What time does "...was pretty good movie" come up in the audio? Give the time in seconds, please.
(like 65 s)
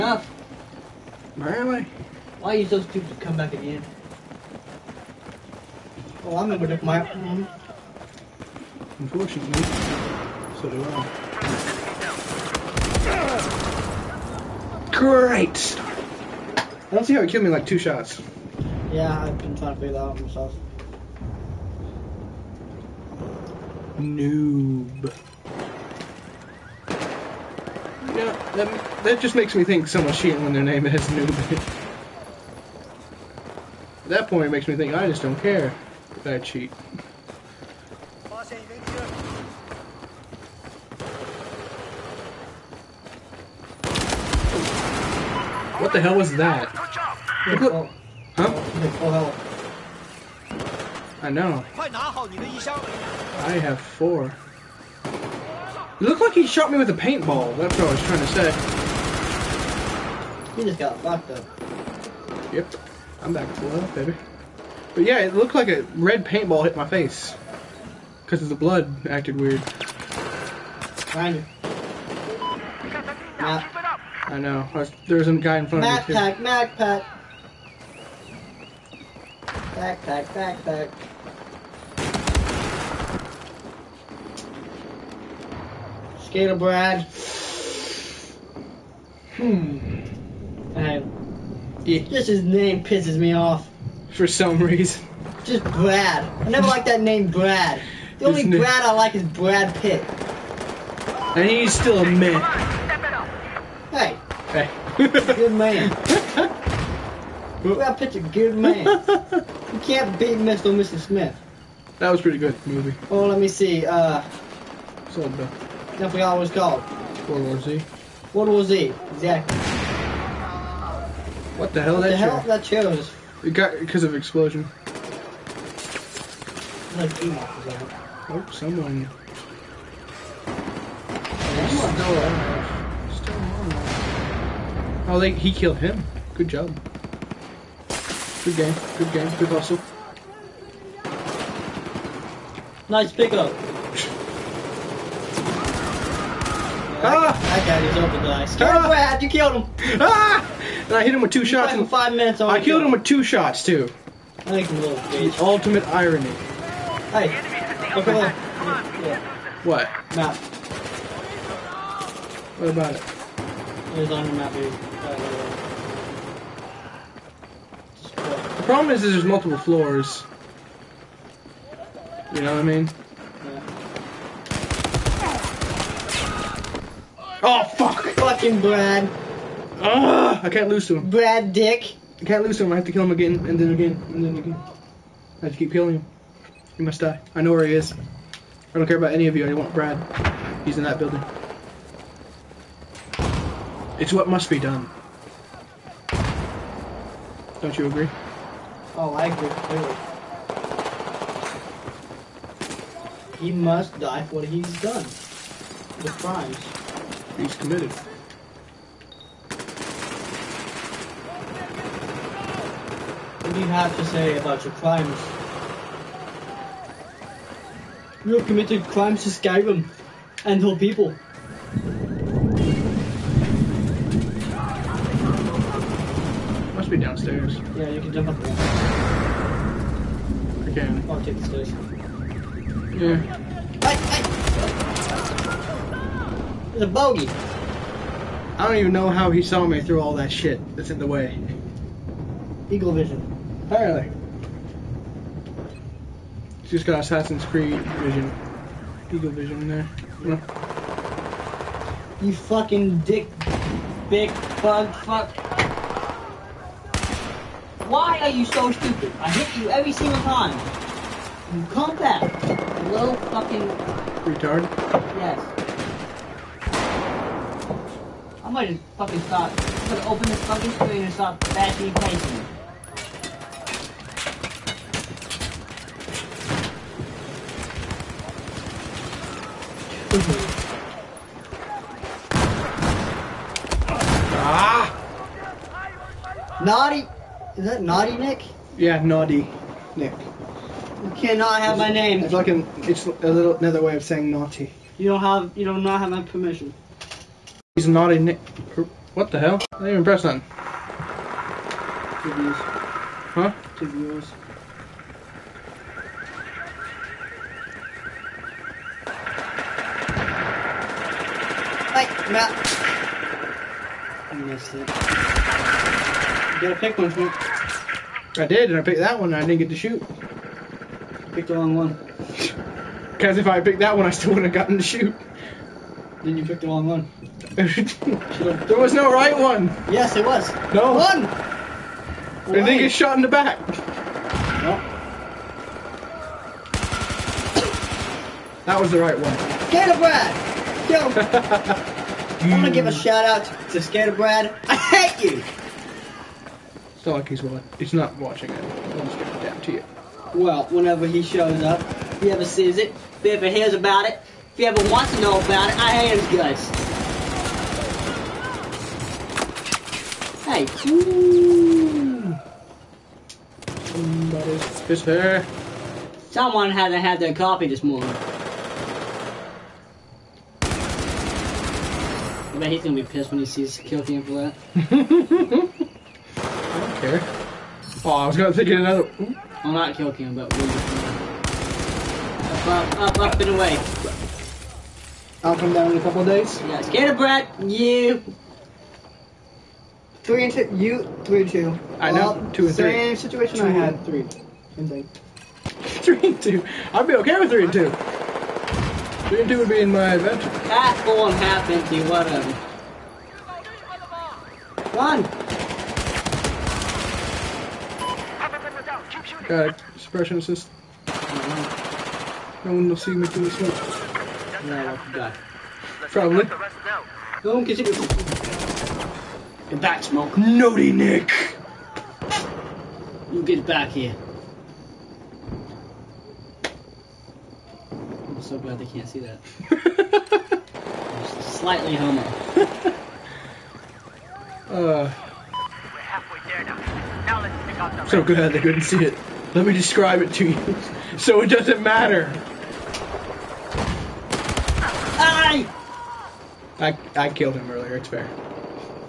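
112 s.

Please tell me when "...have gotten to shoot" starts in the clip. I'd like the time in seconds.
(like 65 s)
324 s.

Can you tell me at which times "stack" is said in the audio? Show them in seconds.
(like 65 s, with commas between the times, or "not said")
not said.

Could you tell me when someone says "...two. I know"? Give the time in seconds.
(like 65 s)
391 s.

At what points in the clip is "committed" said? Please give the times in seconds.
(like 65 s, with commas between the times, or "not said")
207 s, 218 s.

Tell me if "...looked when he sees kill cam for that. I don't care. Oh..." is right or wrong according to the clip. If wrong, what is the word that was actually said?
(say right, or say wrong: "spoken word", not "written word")
wrong: "pissed", not "looked".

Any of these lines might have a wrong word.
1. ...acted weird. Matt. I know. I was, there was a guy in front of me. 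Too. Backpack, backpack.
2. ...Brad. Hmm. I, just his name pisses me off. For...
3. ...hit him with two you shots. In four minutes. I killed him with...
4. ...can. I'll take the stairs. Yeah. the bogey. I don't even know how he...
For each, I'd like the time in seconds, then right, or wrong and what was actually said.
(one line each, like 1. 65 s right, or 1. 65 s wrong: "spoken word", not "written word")
1. 69 s right
2. 86 s right
3. 151 s wrong: "five", not "four"
4. 230 s right.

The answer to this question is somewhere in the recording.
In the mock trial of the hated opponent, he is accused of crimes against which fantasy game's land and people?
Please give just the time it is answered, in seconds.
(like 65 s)
219 s.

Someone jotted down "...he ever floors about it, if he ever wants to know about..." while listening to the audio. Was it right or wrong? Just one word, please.
wrong.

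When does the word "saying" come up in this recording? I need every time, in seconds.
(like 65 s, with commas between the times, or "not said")
294 s.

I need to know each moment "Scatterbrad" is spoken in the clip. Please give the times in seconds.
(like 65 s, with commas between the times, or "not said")
339 s, 343 s.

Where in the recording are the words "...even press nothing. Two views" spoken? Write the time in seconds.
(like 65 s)
299 s.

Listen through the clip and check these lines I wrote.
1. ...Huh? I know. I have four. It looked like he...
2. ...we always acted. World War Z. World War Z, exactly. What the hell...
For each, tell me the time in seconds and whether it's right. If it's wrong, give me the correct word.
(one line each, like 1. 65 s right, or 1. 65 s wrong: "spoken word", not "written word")
1. 48 s right
2. 116 s wrong: "called", not "acted".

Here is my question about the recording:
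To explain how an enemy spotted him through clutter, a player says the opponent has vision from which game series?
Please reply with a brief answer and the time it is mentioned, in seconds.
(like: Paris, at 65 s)
Assassin's Creed, at 247 s.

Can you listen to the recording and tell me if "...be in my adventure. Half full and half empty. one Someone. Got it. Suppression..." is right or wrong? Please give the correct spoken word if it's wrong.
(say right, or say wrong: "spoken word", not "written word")
wrong: "One", not "Someone".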